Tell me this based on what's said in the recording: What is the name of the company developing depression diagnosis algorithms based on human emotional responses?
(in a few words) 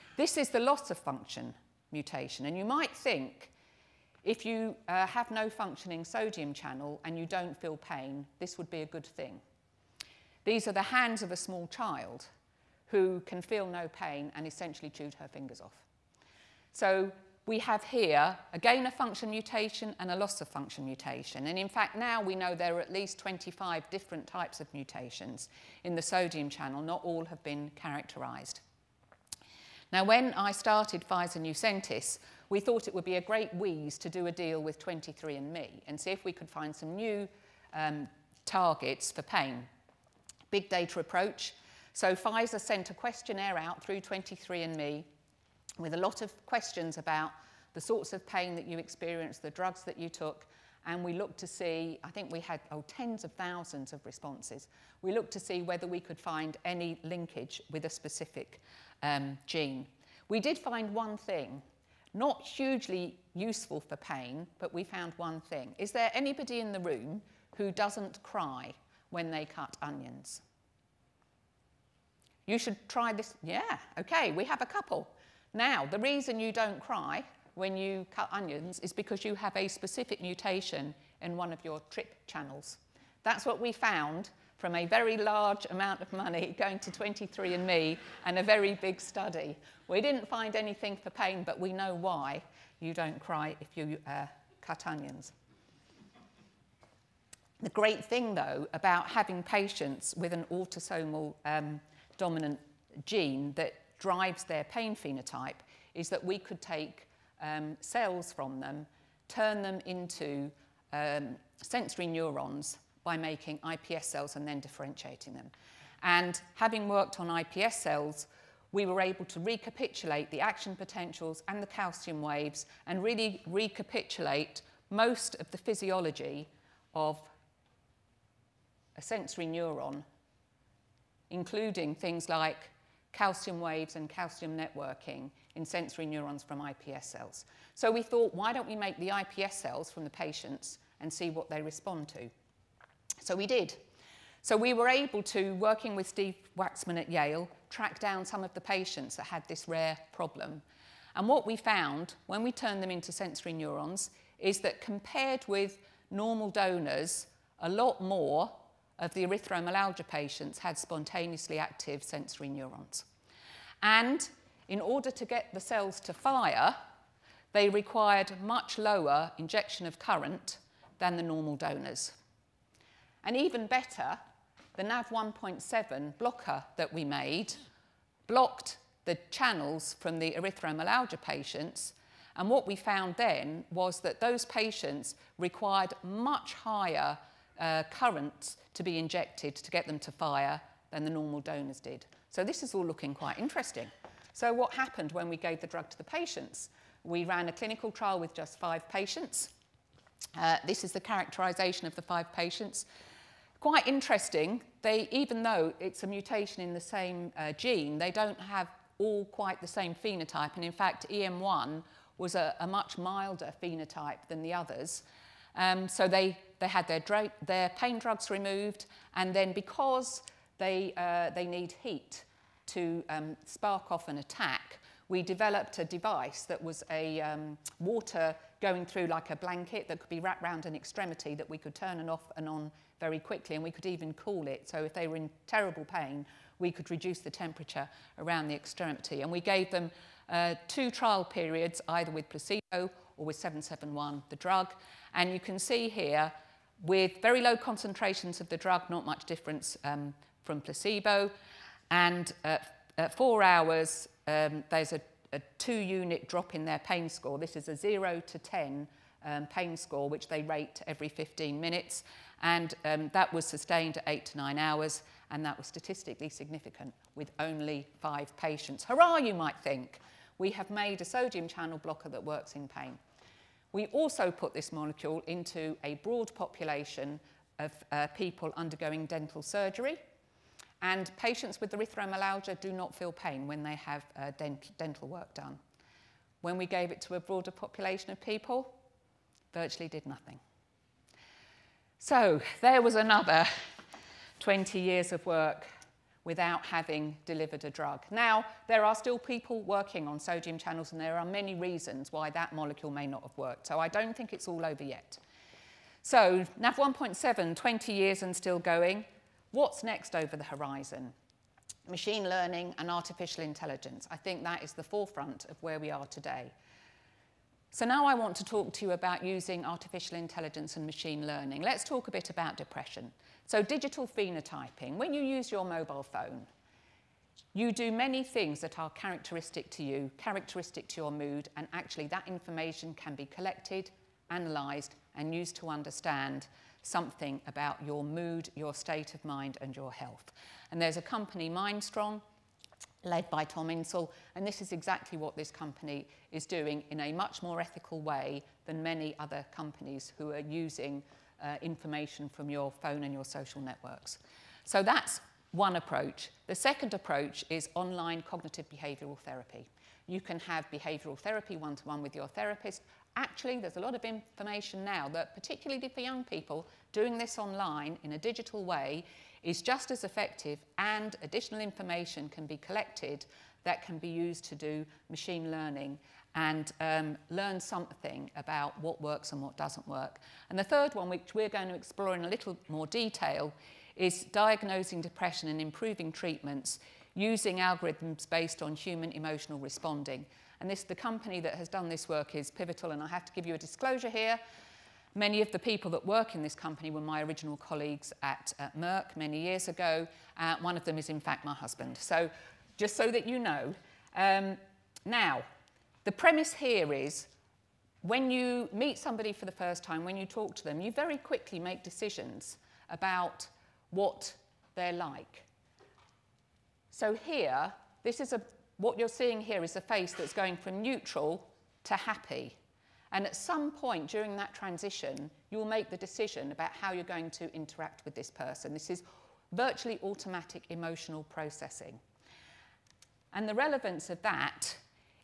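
Pivotal.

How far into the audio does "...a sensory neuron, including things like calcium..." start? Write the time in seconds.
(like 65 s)
128 s.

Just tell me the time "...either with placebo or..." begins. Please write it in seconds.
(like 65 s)
241 s.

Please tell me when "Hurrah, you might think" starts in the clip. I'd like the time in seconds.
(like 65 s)
268 s.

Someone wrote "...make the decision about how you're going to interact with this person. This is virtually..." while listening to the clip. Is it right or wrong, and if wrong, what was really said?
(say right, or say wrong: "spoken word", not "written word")
right.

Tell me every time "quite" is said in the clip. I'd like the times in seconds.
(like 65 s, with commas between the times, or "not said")
193 s, 203 s, 209 s.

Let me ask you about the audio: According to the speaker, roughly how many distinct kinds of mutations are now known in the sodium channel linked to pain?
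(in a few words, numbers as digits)
at least 25.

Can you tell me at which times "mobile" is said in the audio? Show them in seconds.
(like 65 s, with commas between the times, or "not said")
325 s.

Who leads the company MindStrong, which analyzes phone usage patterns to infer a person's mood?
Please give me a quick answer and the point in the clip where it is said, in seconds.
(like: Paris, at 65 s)
Tom Insel, at 343 s.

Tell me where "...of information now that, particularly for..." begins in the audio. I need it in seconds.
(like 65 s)
363 s.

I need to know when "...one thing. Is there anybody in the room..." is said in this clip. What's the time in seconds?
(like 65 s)
65 s.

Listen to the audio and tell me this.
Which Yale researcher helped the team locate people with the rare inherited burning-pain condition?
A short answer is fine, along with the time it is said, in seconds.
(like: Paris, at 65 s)
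Steve Waxman, at 146 s.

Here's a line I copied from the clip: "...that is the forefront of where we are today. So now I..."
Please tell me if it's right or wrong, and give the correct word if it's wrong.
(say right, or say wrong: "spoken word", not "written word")
right.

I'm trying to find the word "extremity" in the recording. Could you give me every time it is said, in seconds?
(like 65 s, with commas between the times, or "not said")
230 s, 238 s.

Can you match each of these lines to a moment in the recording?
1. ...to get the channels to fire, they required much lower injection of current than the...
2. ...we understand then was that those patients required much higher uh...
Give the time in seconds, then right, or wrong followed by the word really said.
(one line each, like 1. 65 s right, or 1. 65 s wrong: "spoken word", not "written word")
1. 165 s wrong: "cells", not "channels"
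2. 182 s wrong: "found", not "understand".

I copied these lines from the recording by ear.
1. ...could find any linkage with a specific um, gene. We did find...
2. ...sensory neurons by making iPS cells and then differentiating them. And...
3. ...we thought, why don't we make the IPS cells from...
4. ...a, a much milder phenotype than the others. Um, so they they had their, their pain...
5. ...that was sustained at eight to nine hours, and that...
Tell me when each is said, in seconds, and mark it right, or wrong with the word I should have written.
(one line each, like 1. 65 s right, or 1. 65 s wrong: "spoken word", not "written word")
1. 55 s right
2. 111 s right
3. 137 s right
4. 212 s right
5. 263 s right.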